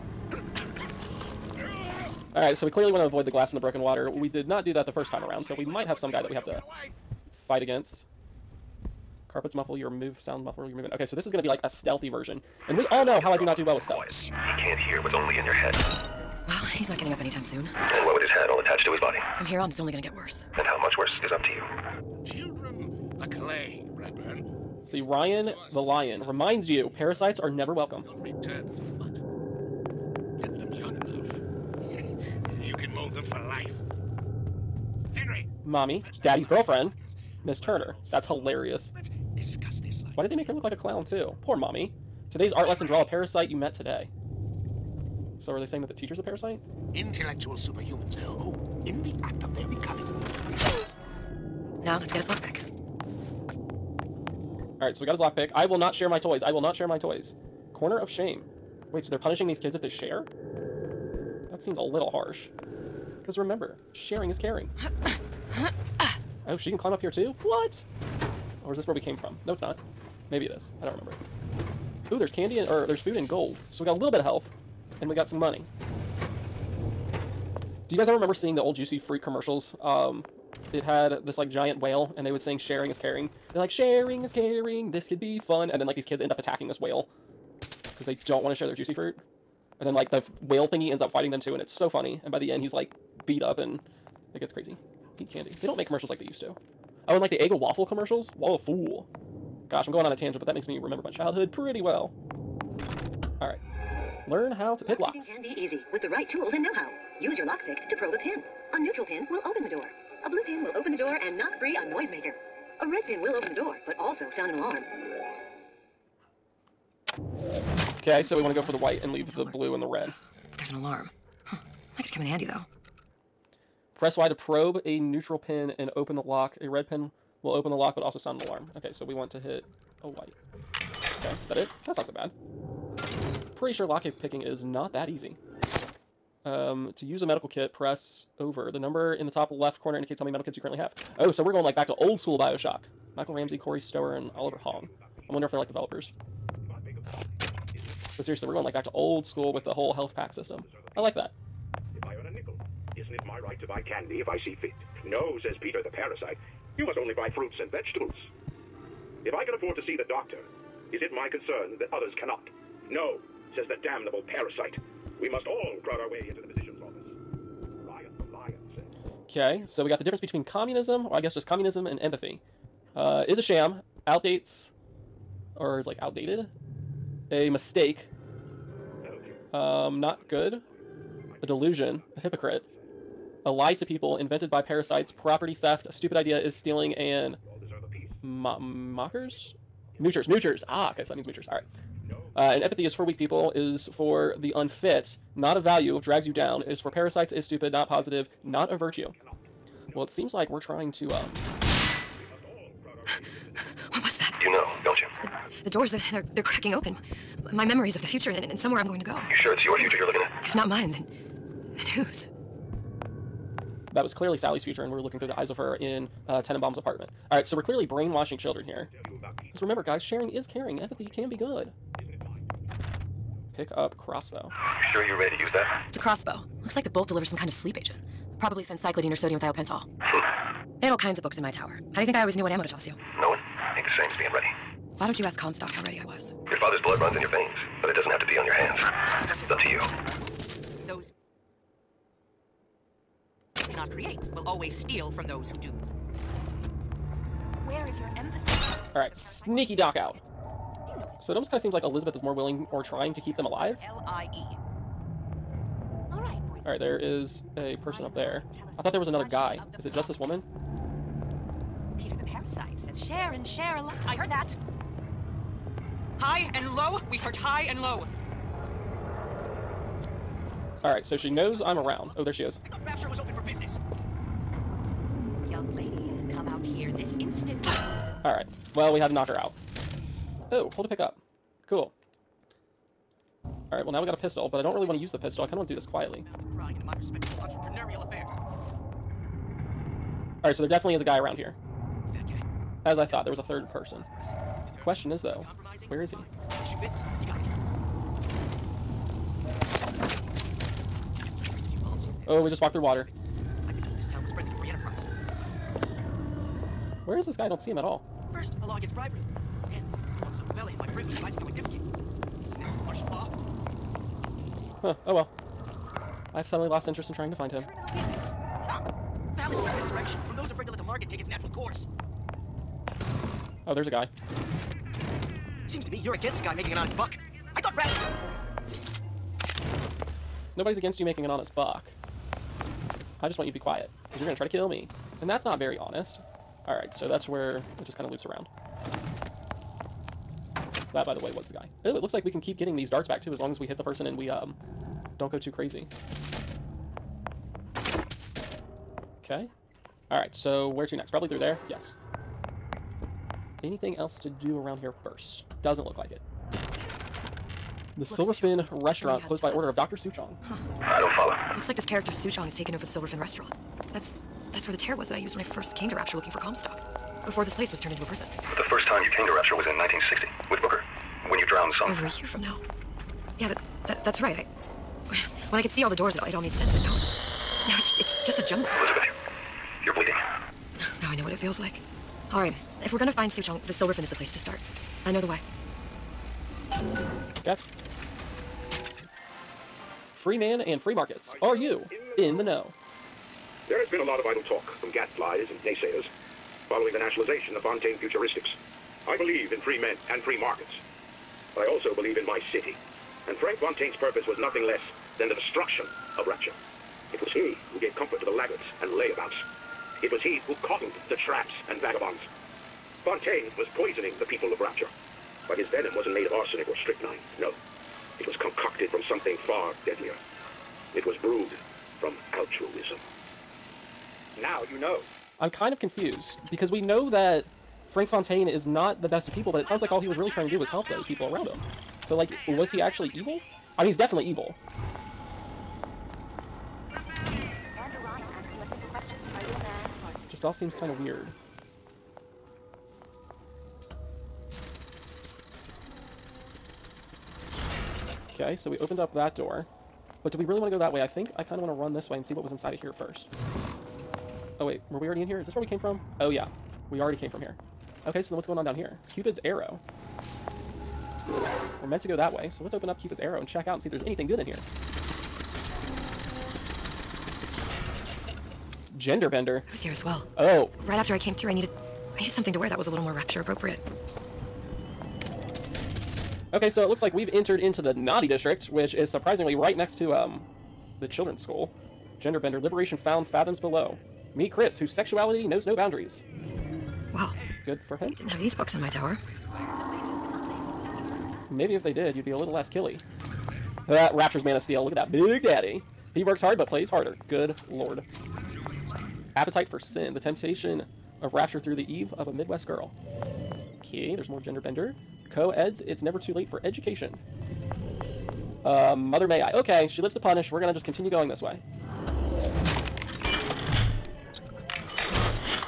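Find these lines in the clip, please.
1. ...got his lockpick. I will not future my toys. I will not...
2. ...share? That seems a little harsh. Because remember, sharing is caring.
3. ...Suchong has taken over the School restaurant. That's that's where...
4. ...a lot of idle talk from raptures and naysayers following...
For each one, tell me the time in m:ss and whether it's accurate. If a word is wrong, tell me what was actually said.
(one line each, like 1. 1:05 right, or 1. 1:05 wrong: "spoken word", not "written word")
1. 0:55 wrong: "share", not "future"
2. 0:59 right
3. 6:02 wrong: "Silverfin", not "School"
4. 6:33 wrong: "gadflies", not "raptures".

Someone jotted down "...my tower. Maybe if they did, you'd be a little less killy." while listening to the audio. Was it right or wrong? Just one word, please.
right.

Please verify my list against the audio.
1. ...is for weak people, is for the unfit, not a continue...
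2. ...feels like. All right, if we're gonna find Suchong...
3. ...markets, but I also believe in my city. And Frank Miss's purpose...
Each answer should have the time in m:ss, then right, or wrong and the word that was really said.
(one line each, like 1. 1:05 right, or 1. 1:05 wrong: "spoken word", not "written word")
1. 3:12 wrong: "value", not "continue"
2. 6:21 right
3. 6:40 wrong: "Fontaine", not "Miss".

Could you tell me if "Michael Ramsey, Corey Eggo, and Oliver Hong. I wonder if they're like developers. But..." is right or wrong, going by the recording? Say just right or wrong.
wrong.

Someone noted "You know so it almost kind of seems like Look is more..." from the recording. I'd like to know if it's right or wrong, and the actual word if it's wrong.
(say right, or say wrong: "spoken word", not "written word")
wrong: "Elizabeth", not "Look".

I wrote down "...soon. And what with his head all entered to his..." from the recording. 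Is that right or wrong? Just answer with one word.
wrong.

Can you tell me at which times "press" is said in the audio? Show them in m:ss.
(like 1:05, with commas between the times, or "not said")
2:03, 2:17.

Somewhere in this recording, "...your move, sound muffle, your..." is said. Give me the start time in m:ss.
0:09.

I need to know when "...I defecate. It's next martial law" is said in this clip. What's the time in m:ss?
5:11.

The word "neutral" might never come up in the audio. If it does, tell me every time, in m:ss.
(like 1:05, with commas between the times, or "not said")
1:48, 2:04.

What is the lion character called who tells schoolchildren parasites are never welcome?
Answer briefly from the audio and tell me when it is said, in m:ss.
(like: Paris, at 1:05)
Ryan the Lion, at 0:25.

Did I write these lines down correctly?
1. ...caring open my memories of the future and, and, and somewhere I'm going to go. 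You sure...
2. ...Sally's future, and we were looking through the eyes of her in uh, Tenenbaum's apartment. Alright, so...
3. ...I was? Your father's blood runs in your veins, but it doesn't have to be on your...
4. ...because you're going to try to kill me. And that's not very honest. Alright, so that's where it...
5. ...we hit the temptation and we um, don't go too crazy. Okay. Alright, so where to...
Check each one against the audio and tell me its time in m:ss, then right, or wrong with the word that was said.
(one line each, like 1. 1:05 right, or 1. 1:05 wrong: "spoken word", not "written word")
1. 3:26 wrong: "cracking", not "caring"
2. 3:34 right
3. 3:56 right
4. 5:34 right
5. 5:43 wrong: "person", not "temptation".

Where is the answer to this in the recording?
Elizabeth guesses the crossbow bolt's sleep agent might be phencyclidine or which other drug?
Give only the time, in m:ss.
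3:49.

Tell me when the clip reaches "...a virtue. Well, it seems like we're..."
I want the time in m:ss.
3:18.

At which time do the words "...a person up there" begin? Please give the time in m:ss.
4:17.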